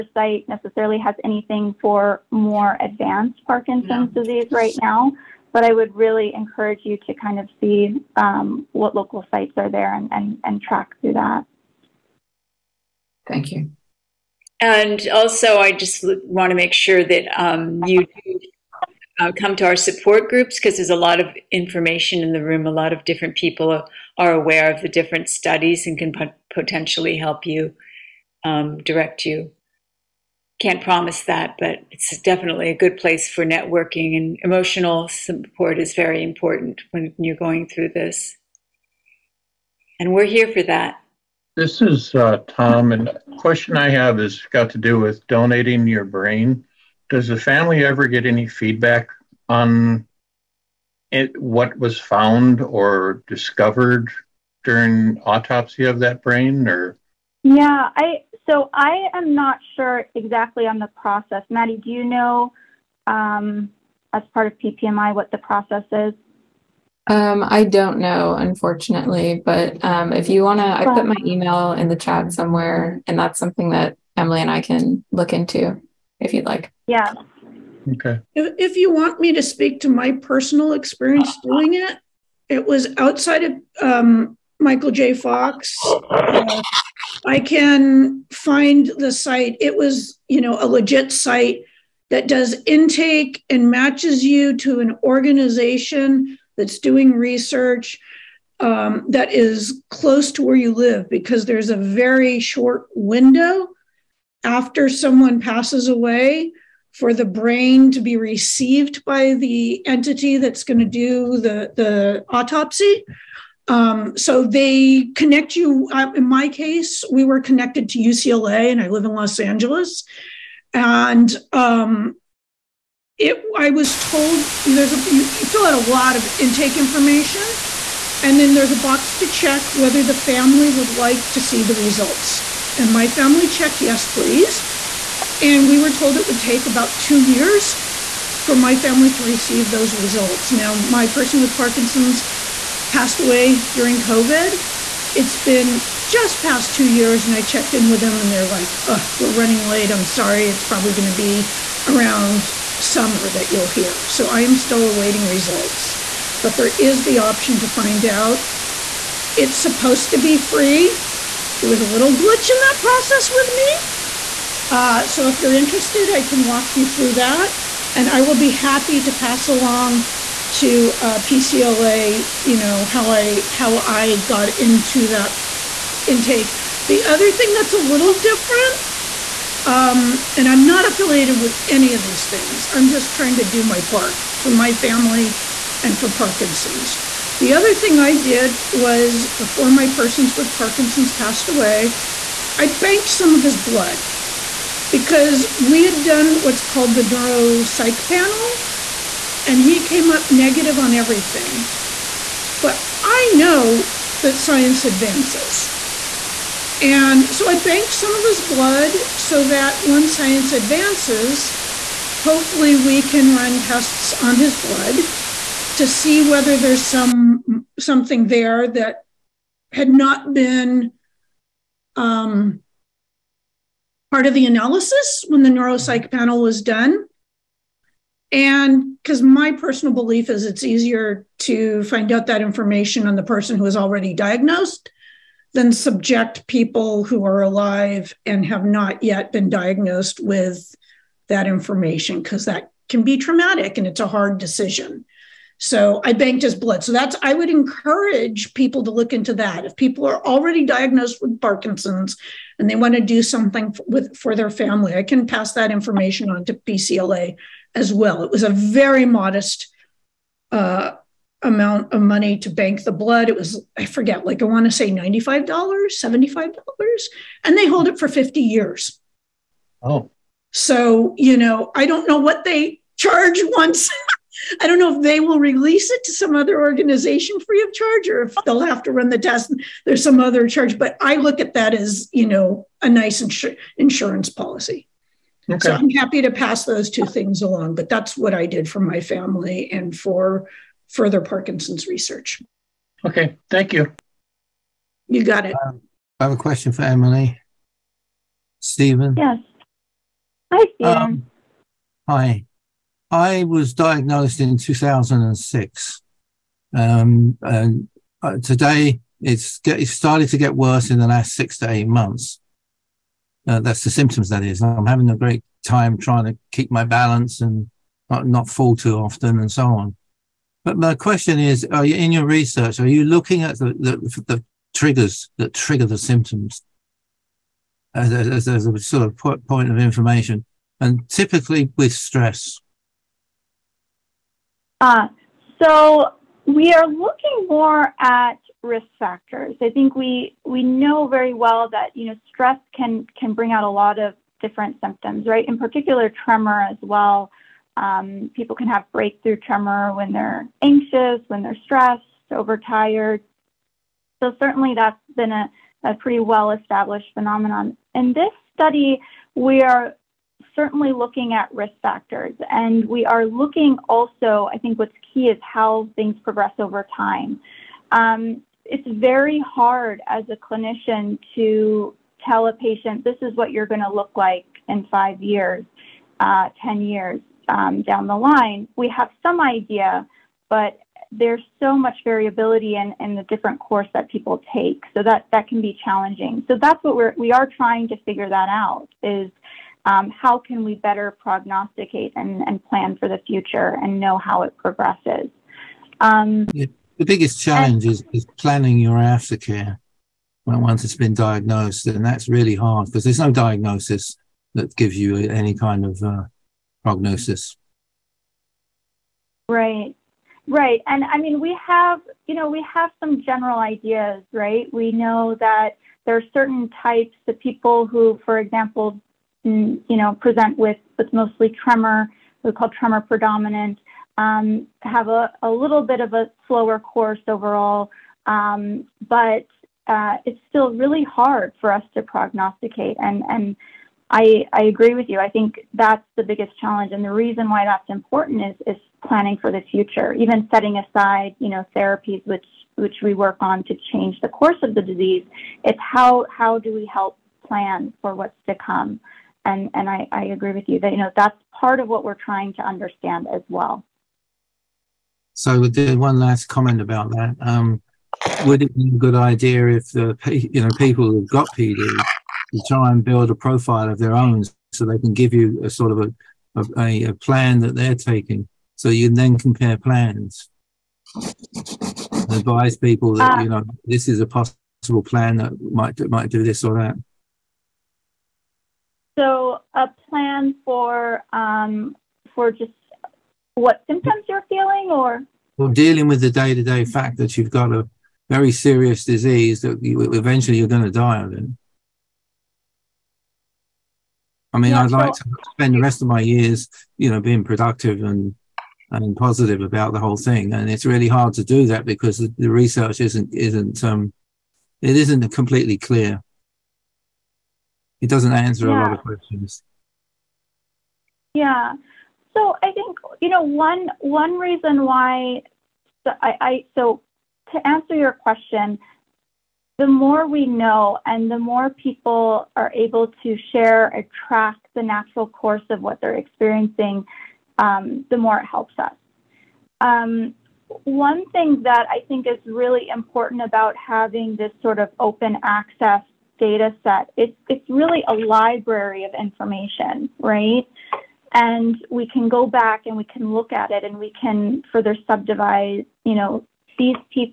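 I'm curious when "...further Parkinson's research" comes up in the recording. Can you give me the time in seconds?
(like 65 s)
290 s.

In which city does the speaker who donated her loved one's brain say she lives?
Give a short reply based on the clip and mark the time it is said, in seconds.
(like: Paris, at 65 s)
Los Angeles, at 119 s.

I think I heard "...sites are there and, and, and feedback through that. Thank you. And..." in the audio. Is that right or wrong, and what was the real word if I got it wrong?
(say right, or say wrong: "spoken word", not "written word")
wrong: "track", not "feedback".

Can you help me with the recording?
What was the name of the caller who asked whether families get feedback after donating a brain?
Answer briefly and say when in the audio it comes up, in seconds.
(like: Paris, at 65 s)
Tom, at 42 s.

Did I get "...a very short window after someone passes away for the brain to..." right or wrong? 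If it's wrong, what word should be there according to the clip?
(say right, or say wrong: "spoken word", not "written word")
right.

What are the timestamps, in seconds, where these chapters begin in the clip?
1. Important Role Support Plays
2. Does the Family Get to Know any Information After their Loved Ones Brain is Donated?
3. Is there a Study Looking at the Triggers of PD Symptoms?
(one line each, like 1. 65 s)
1. 14 s
2. 41 s
3. 295 s.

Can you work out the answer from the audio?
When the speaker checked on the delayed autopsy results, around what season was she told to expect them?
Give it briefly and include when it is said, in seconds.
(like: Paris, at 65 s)
Summer, at 152 s.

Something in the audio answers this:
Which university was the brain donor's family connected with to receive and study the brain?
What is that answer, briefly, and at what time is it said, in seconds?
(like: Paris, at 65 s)
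UCLA, at 117 s.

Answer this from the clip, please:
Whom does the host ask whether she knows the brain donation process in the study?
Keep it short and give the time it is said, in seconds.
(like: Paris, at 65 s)
Maddie, at 61 s.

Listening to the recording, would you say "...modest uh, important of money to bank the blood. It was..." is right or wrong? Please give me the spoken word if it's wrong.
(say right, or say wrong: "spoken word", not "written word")
wrong: "amount", not "important".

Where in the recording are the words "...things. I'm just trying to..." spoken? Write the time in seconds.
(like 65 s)
182 s.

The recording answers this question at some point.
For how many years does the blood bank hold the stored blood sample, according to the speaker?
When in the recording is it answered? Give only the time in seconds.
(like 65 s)
268 s.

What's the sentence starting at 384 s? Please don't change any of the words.
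So that, that can be challenging.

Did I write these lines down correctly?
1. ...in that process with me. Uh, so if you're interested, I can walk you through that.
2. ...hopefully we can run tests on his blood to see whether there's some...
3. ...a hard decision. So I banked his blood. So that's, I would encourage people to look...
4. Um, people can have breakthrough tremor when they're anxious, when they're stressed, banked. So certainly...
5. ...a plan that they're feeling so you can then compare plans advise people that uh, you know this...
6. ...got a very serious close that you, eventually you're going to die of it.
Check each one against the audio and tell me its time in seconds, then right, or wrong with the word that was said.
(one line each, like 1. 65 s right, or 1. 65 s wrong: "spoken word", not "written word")
1. 162 s right
2. 212 s right
3. 244 s right
4. 347 s wrong: "overtired", not "banked"
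5. 467 s wrong: "taking", not "feeling"
6. 487 s wrong: "disease", not "close".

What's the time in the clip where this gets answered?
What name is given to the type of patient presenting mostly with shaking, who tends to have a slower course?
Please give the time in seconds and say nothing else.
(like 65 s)
422 s.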